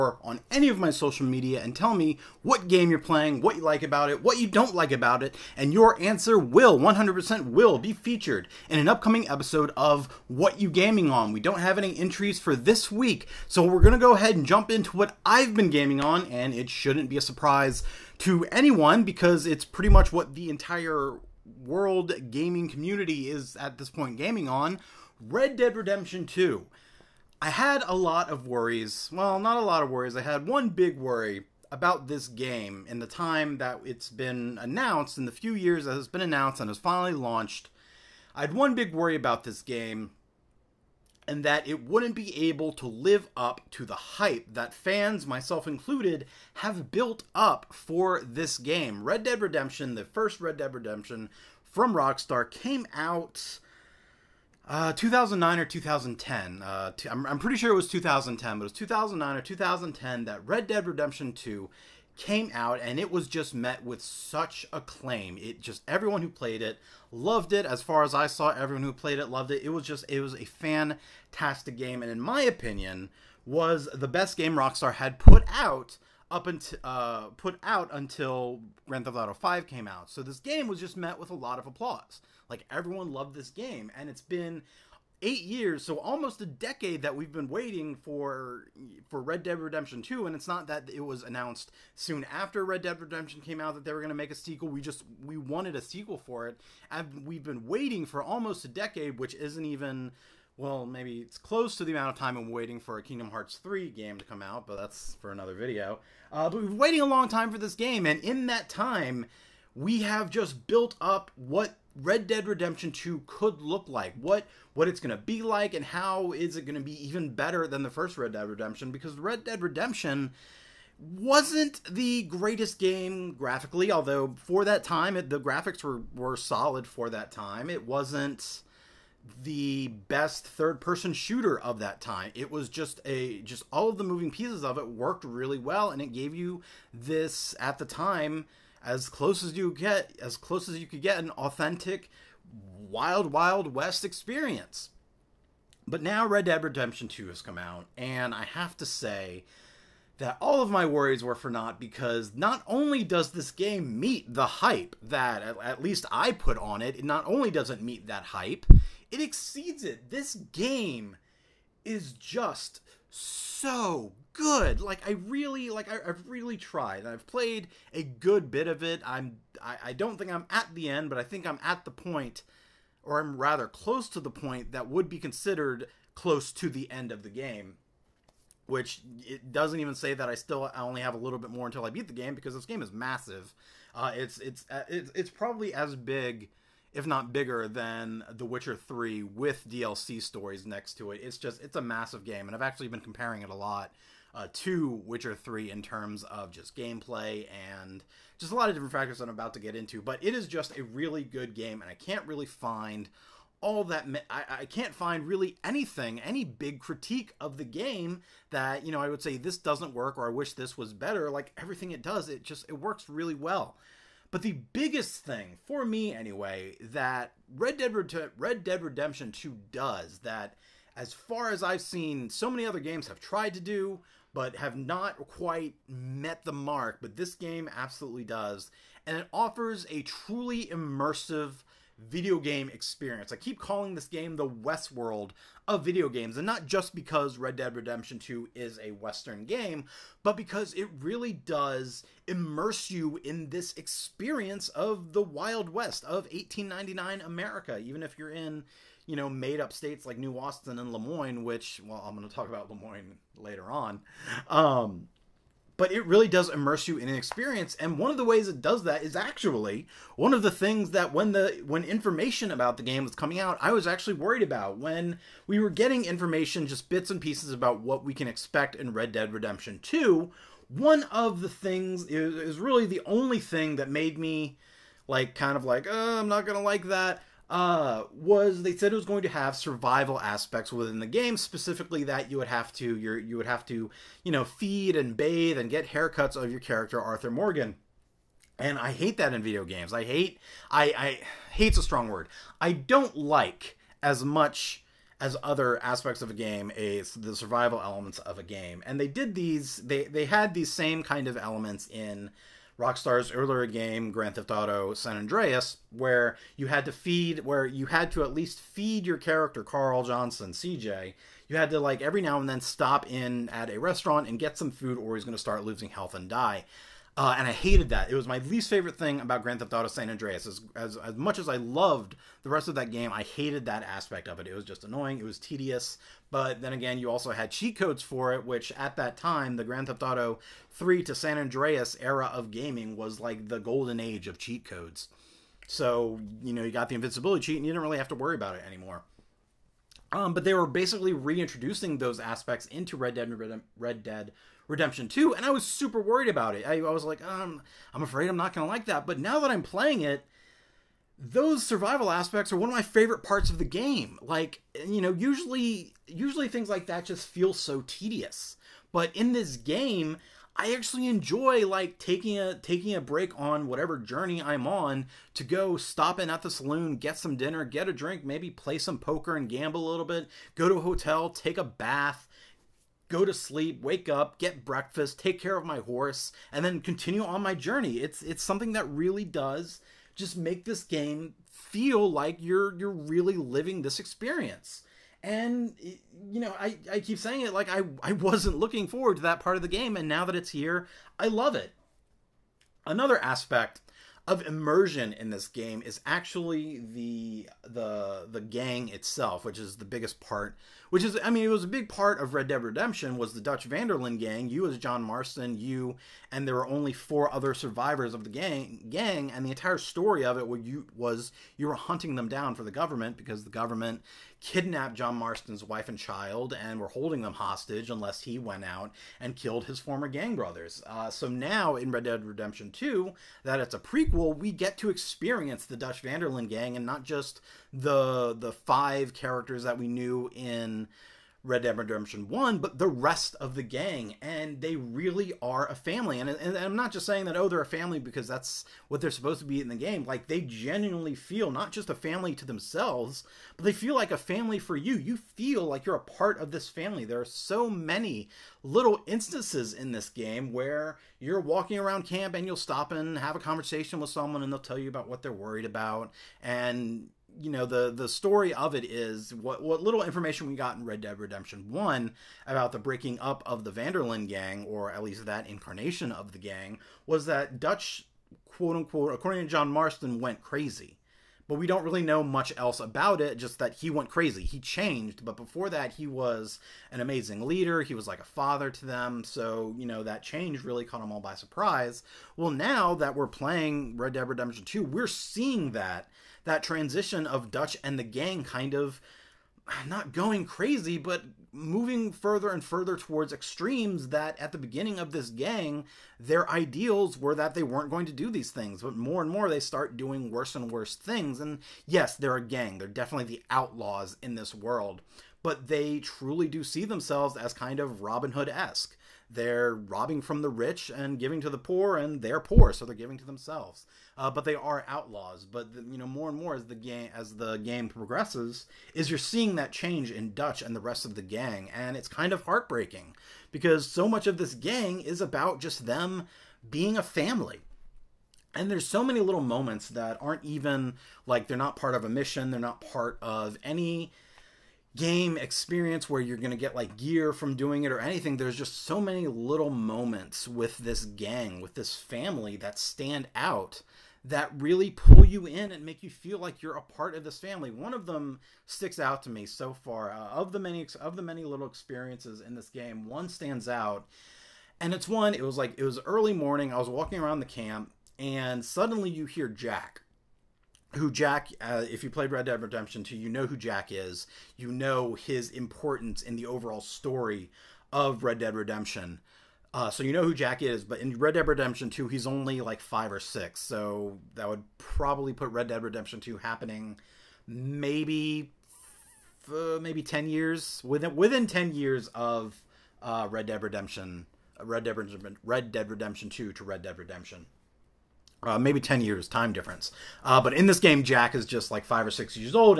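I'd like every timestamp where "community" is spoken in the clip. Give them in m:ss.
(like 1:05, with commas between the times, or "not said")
0:22.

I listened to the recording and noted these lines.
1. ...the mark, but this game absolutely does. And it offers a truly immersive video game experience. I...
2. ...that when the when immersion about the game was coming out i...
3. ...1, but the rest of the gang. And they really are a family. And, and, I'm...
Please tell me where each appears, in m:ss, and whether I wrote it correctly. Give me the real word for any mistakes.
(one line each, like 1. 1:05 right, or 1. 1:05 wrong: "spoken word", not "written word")
1. 3:46 right
2. 4:20 wrong: "information", not "immersion"
3. 7:12 right.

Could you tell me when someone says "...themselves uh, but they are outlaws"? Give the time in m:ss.
8:33.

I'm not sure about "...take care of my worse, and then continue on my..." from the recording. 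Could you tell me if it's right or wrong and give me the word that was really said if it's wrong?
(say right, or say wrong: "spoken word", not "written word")
wrong: "horse", not "worse".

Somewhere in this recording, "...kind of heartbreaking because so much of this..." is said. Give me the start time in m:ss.
8:42.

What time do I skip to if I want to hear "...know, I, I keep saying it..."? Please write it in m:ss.
6:26.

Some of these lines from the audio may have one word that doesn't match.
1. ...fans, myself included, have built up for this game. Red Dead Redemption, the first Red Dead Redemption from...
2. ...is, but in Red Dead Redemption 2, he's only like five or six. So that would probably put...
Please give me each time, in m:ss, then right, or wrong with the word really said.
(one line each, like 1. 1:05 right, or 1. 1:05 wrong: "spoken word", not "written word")
1. 0:44 right
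2. 9:30 right.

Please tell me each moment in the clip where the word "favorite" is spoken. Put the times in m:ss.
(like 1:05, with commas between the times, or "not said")
5:18, 5:52.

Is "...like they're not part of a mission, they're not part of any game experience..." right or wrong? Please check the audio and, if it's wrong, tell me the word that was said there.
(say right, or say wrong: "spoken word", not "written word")
right.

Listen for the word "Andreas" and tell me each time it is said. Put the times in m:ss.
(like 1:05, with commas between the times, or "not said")
5:05, 5:20, 5:31.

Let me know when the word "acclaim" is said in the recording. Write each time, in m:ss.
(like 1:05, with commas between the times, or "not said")
1:04.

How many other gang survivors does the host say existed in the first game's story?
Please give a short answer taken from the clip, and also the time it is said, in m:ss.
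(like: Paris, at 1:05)
4, at 6:46.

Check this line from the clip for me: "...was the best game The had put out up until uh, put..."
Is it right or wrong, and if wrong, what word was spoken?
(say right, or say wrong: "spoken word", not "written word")
wrong: "Rockstar", not "The".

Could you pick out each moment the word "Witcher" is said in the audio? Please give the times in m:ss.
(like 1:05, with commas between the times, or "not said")
3:08, 3:15.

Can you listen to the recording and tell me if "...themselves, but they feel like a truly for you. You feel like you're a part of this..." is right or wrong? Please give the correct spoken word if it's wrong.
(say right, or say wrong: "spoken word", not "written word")
wrong: "family", not "truly".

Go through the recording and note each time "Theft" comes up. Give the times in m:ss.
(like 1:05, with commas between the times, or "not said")
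1:19, 5:04, 5:19, 5:29.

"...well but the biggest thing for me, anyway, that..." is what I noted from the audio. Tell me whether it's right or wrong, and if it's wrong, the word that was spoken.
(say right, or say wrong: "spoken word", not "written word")
right.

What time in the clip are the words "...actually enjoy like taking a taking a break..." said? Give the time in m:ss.
6:00.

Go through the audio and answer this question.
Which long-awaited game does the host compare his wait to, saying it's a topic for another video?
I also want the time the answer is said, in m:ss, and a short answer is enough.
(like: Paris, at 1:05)
Kingdom Hearts 3, at 1:43.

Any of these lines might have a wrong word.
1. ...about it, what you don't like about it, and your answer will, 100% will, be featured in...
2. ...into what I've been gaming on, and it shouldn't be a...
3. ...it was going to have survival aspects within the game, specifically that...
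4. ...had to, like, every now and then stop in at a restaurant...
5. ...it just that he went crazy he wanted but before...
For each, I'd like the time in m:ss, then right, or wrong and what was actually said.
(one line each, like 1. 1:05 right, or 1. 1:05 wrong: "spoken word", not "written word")
1. 0:03 right
2. 0:14 right
3. 4:38 right
4. 5:11 right
5. 7:53 wrong: "changed", not "wanted".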